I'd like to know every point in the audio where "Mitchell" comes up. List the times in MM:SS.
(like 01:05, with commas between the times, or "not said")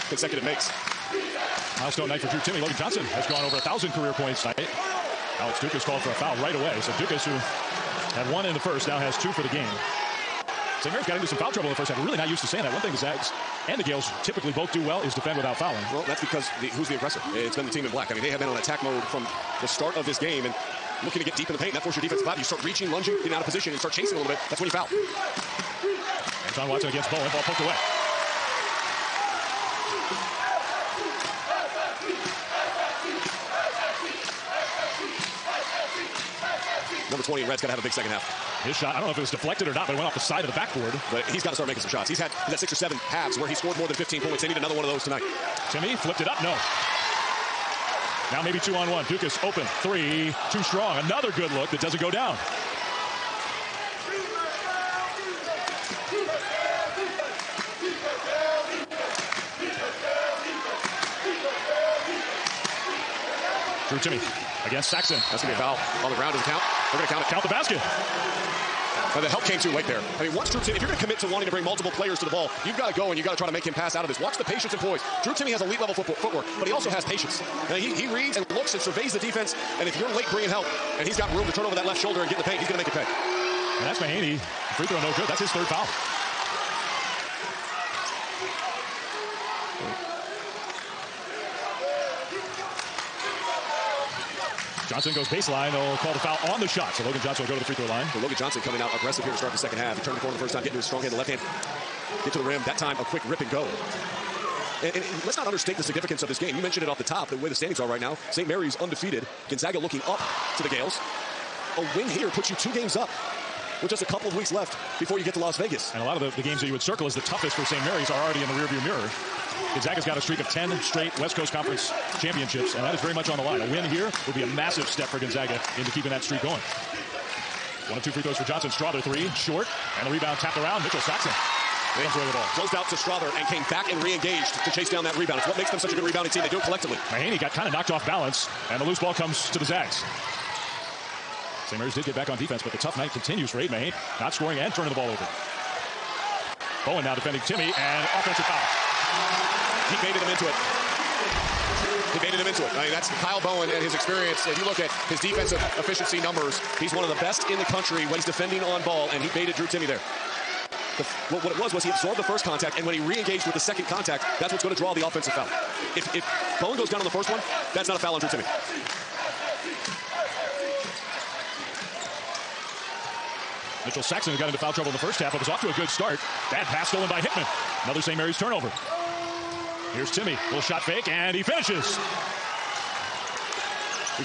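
02:10, 02:53.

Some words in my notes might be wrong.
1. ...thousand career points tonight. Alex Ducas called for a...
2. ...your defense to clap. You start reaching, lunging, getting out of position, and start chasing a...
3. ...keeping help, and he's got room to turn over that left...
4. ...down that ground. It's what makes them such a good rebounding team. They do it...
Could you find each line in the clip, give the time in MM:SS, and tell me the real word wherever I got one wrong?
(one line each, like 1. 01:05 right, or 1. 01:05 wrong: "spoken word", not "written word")
1. 00:03 right
2. 00:21 right
3. 01:20 wrong: "bringing", not "keeping"
4. 02:14 wrong: "rebound", not "ground".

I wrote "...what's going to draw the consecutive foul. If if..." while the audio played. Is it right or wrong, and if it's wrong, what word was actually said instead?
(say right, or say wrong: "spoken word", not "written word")
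wrong: "offensive", not "consecutive".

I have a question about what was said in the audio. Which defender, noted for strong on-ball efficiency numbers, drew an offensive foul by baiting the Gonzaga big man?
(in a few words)
Kyle Bowen.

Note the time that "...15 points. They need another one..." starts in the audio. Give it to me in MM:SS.
00:43.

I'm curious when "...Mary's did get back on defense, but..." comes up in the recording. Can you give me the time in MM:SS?
02:21.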